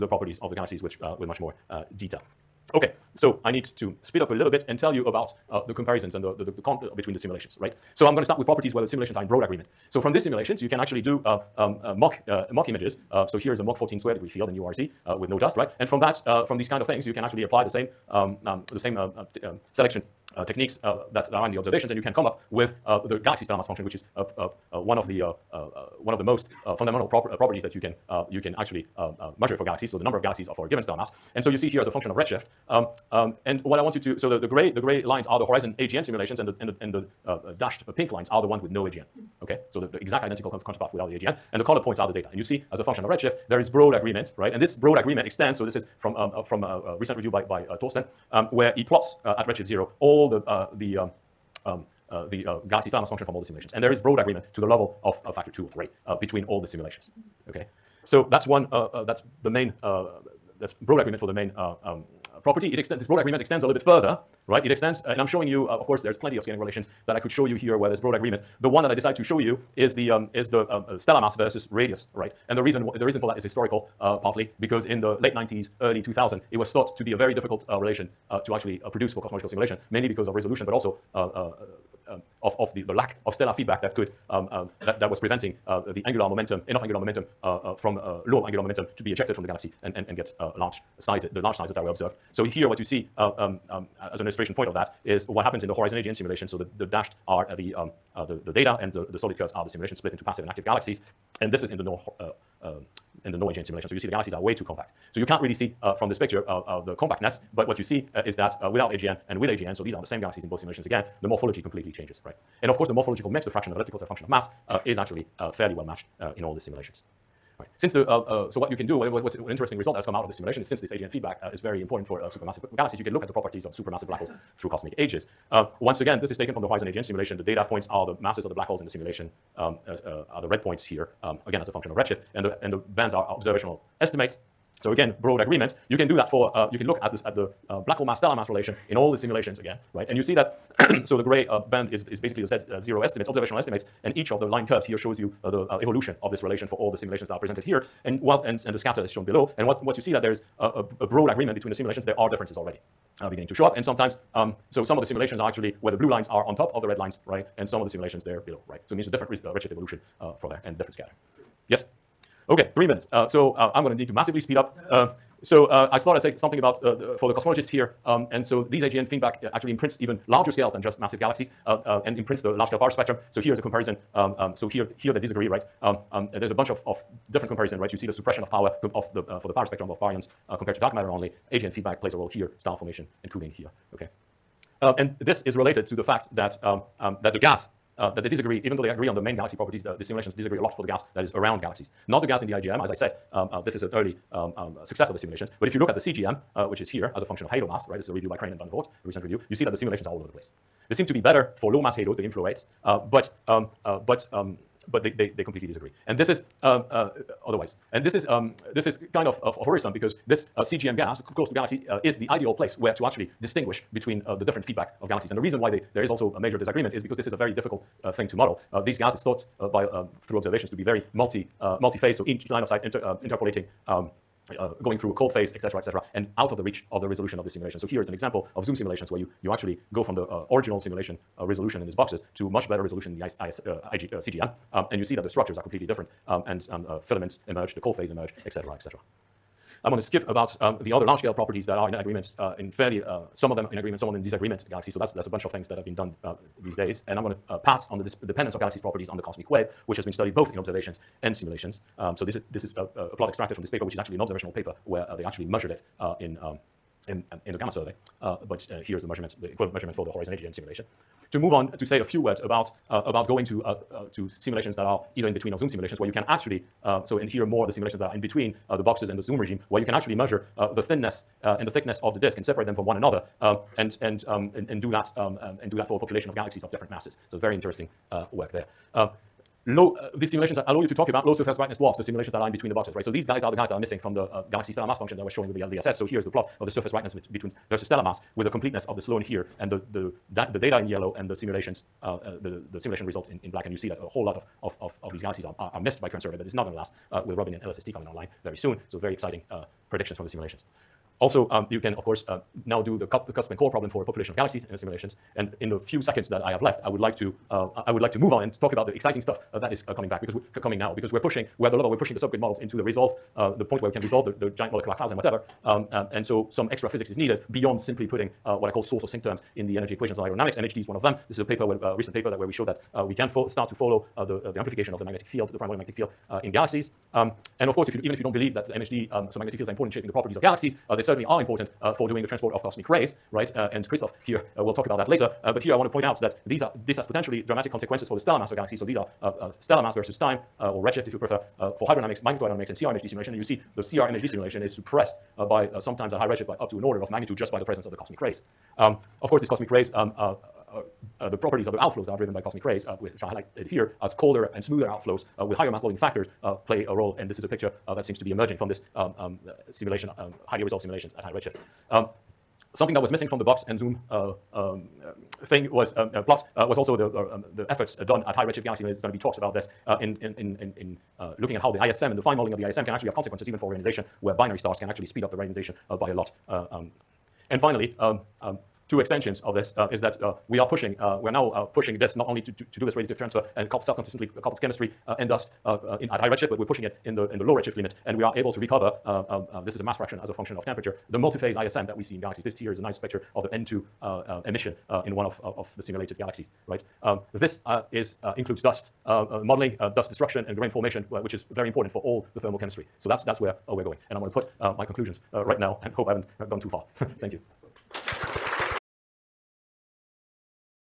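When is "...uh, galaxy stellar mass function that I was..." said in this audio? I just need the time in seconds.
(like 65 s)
284 s.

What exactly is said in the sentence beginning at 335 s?
Uh, but here I want to point out that these are, this has potentially dramatic consequences for the stellar mass of galaxies.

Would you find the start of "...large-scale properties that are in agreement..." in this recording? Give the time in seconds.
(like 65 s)
241 s.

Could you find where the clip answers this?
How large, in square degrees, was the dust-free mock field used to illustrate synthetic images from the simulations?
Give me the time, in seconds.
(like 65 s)
13 s.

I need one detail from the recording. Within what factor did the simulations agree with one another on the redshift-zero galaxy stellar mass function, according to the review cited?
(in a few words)
two or three.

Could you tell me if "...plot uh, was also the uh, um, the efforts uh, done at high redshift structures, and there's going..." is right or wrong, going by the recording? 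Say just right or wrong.
wrong.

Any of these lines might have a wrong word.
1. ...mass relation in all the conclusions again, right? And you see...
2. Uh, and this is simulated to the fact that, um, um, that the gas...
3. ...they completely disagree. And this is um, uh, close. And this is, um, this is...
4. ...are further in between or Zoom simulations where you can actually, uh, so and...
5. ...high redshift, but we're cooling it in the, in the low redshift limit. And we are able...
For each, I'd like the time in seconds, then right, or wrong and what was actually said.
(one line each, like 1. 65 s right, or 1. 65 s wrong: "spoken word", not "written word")
1. 138 s wrong: "simulations", not "conclusions"
2. 184 s wrong: "related", not "simulated"
3. 205 s wrong: "otherwise", not "close"
4. 264 s wrong: "either", not "further"
5. 386 s wrong: "pushing", not "cooling".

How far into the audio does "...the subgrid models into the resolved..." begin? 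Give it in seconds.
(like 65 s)
312 s.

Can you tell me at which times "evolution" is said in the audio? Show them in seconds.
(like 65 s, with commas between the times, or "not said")
145 s, 159 s.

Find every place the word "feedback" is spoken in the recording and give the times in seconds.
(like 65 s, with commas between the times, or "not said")
83 s, 121 s, 169 s, 181 s, 214 s.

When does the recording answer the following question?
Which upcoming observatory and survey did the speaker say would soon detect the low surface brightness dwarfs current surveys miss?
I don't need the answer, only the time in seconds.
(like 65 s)
297 s.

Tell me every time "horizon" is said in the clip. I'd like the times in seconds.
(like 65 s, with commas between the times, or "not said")
35 s, 95 s, 126 s, 260 s.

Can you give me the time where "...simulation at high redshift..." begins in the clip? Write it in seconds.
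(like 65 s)
360 s.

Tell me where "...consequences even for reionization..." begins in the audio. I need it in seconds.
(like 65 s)
373 s.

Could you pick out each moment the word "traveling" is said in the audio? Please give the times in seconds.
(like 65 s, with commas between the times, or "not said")
not said.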